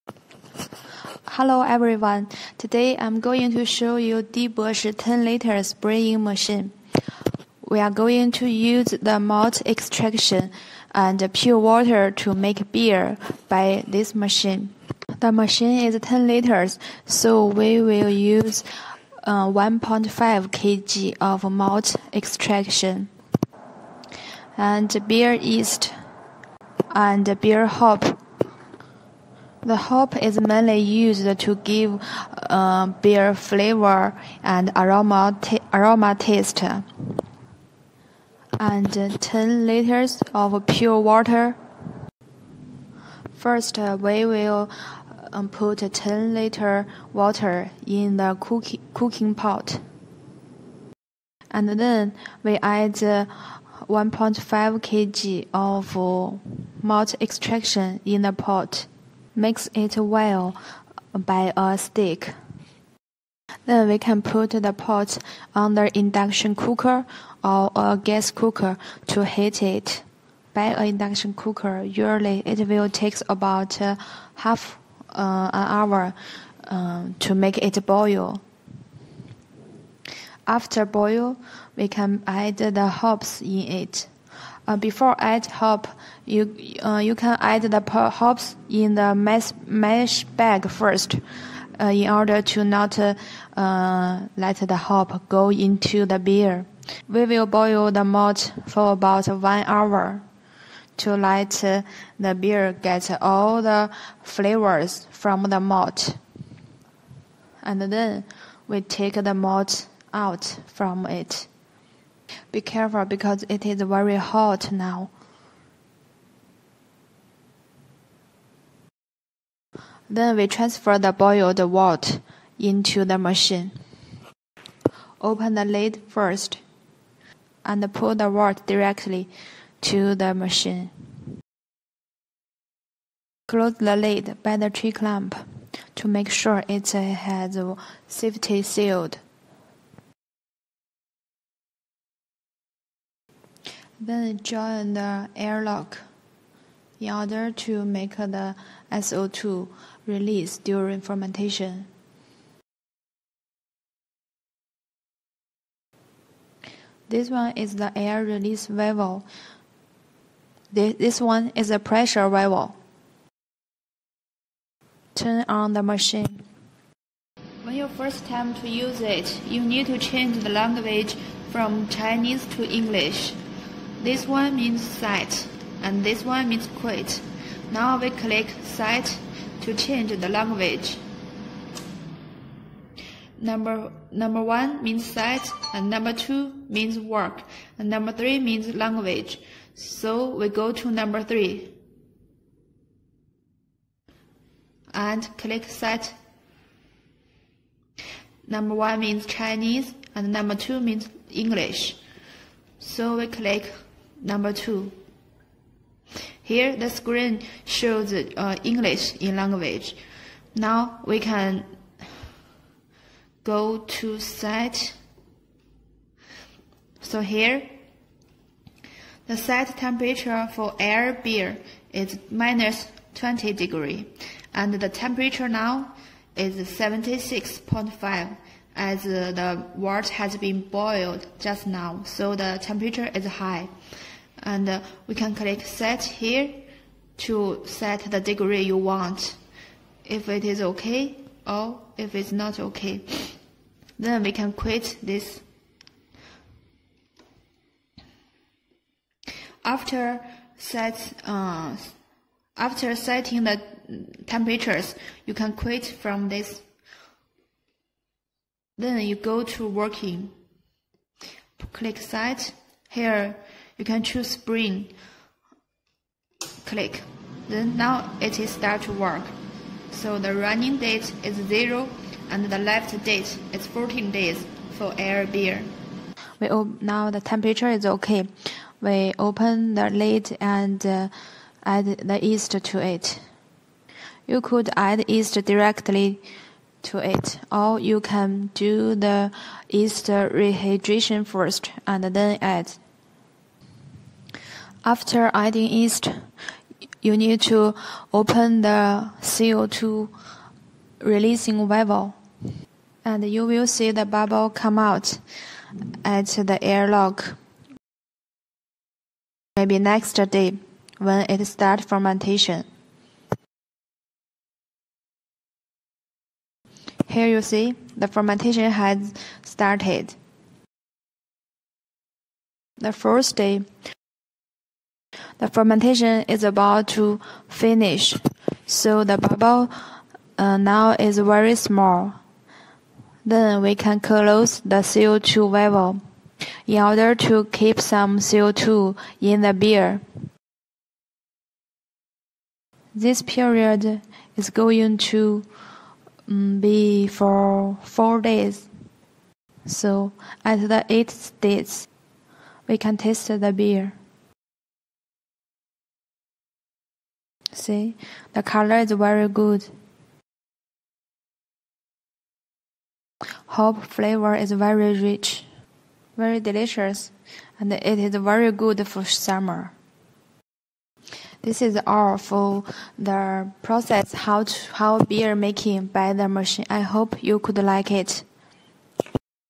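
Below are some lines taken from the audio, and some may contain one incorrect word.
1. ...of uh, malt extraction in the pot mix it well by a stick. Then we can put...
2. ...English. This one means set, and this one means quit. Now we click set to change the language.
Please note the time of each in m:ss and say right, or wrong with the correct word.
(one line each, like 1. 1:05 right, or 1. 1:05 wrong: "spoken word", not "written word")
1. 0:55 right
2. 2:52 right.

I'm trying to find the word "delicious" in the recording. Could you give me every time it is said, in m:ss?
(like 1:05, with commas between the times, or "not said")
6:06.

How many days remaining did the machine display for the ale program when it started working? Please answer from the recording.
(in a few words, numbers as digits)
14 days.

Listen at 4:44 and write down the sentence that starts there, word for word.
You could add yeast directly to it, or you can do the yeast rehydration first and then add.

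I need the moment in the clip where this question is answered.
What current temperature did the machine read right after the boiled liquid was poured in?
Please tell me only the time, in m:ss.
3:46.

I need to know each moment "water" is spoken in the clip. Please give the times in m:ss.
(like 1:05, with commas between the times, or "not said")
0:11, 0:40, 0:47, 2:01, 2:08, 3:49.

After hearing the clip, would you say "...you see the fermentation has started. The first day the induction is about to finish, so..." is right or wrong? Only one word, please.
wrong.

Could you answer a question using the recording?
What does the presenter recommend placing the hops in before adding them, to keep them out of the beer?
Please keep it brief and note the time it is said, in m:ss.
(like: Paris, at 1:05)
mesh bag, at 1:29.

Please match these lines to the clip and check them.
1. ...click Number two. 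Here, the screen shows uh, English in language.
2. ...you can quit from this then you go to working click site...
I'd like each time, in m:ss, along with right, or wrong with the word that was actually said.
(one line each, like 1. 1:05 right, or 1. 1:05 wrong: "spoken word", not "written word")
1. 3:23 right
2. 4:15 right.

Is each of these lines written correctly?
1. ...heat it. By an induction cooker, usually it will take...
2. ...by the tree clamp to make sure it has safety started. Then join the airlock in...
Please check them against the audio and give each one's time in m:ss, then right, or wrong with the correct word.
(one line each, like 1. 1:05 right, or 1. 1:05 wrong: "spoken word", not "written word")
1. 1:09 right
2. 2:14 wrong: "sealed", not "started".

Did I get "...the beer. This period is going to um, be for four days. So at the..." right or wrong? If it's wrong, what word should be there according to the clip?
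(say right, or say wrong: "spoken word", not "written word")
right.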